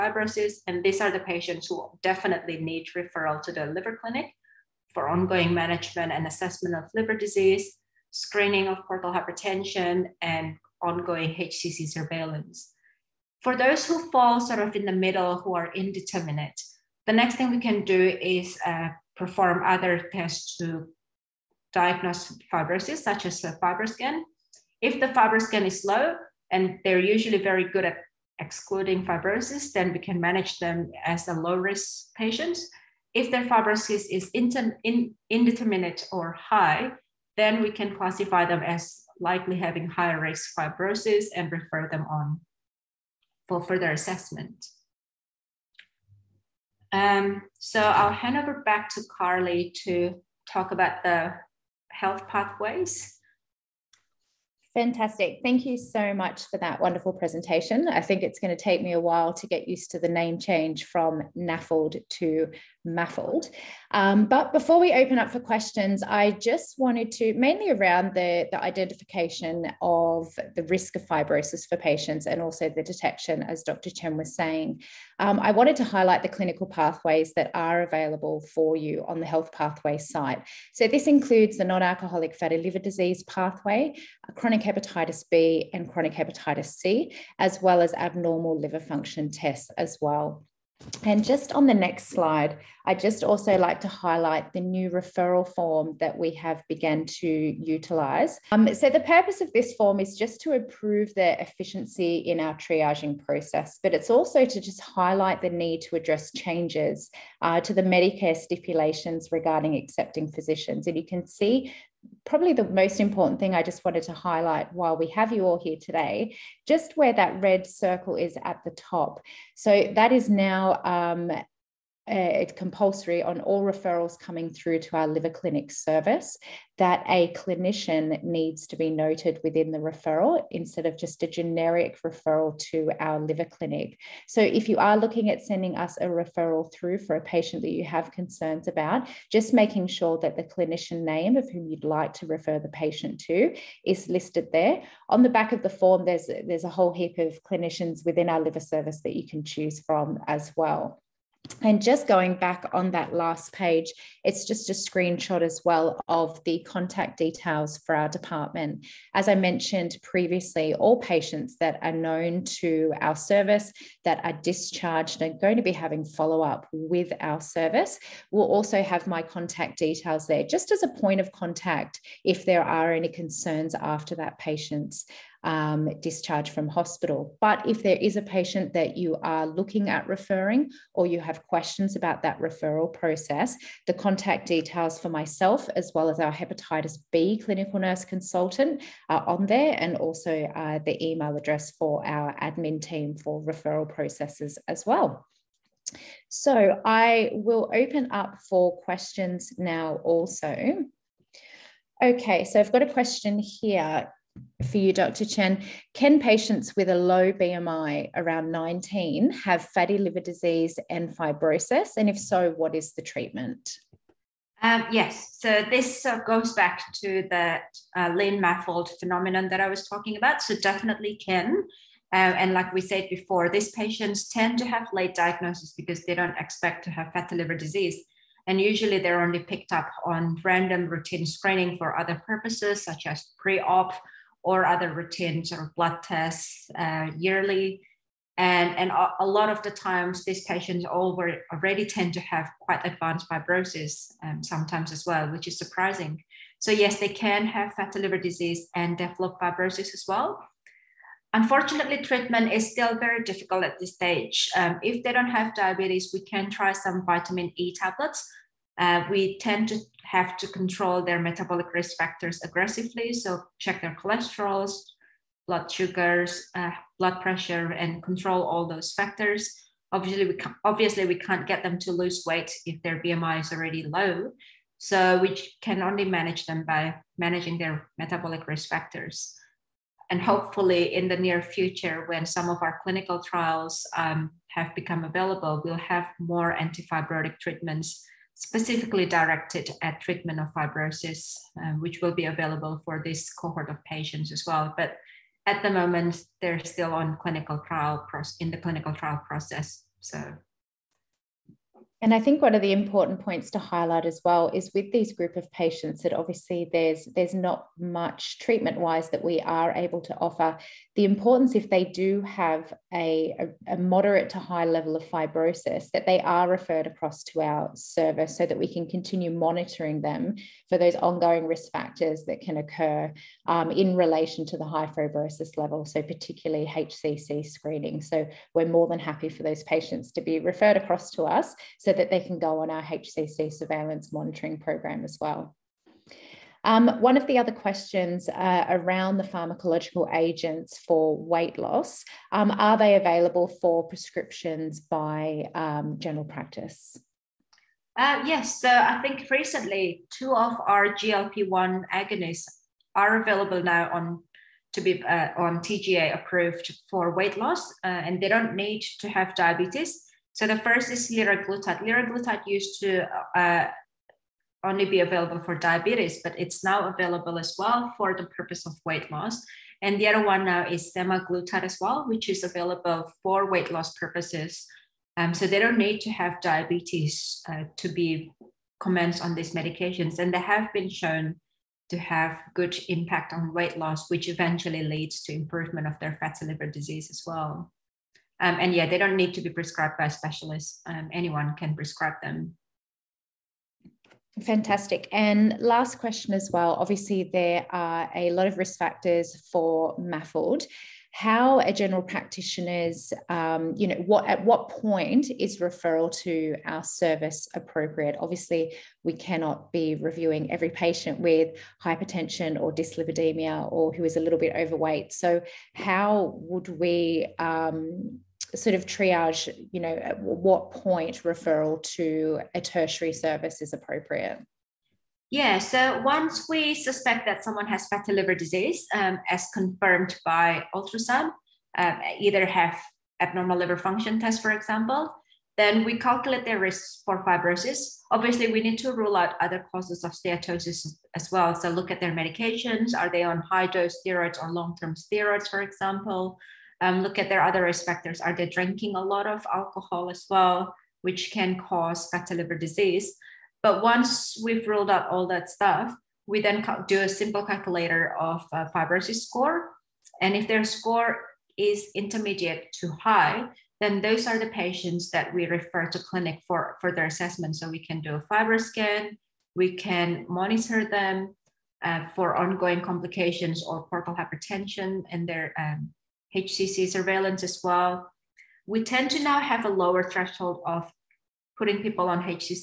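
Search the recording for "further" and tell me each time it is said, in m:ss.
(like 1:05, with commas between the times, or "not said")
0:43, 7:46.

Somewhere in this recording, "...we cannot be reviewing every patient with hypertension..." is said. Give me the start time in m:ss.
6:49.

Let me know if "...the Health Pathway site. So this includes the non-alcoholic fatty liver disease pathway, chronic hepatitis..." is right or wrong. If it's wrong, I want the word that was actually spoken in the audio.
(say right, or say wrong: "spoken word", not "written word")
right.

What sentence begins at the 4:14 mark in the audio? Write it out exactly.
Um, if they don't have diabetes, we can try some vitamin E tablets.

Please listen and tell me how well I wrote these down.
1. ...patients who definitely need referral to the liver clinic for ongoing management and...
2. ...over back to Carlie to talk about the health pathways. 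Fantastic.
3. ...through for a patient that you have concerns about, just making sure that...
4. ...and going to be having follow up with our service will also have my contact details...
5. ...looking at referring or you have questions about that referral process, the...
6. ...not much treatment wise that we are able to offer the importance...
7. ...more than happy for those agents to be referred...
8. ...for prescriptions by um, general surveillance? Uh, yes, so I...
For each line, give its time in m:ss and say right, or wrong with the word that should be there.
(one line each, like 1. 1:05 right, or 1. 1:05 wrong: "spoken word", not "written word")
1. 0:01 right
2. 0:48 right
3. 2:16 right
4. 2:45 right
5. 2:59 right
6. 5:07 right
7. 5:28 wrong: "patients", not "agents"
8. 5:43 wrong: "practice", not "surveillance".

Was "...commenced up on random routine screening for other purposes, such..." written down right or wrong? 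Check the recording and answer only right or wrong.
wrong.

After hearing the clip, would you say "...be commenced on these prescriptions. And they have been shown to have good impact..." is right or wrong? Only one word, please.
wrong.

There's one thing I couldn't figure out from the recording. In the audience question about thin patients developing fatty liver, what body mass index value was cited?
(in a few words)
19.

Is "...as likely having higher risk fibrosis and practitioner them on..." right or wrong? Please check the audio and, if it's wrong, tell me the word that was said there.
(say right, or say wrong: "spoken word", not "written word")
wrong: "refer", not "practitioner".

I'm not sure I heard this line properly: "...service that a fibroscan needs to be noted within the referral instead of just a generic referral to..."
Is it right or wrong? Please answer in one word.
wrong.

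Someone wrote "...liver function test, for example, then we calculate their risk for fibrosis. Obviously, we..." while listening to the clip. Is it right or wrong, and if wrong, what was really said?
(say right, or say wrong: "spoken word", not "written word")
right.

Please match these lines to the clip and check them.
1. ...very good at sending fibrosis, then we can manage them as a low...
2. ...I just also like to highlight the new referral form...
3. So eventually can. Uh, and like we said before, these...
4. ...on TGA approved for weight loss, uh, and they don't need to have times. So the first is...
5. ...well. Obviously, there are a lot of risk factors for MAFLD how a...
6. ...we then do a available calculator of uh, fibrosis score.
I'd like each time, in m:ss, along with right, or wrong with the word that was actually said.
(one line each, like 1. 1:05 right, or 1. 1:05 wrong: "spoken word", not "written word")
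1. 0:27 wrong: "excluding", not "sending"
2. 1:32 right
3. 3:40 wrong: "definitely", not "eventually"
4. 5:55 wrong: "diabetes", not "times"
5. 6:36 right
6. 7:36 wrong: "simple", not "available".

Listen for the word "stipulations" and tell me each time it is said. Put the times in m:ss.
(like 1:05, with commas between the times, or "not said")
1:48.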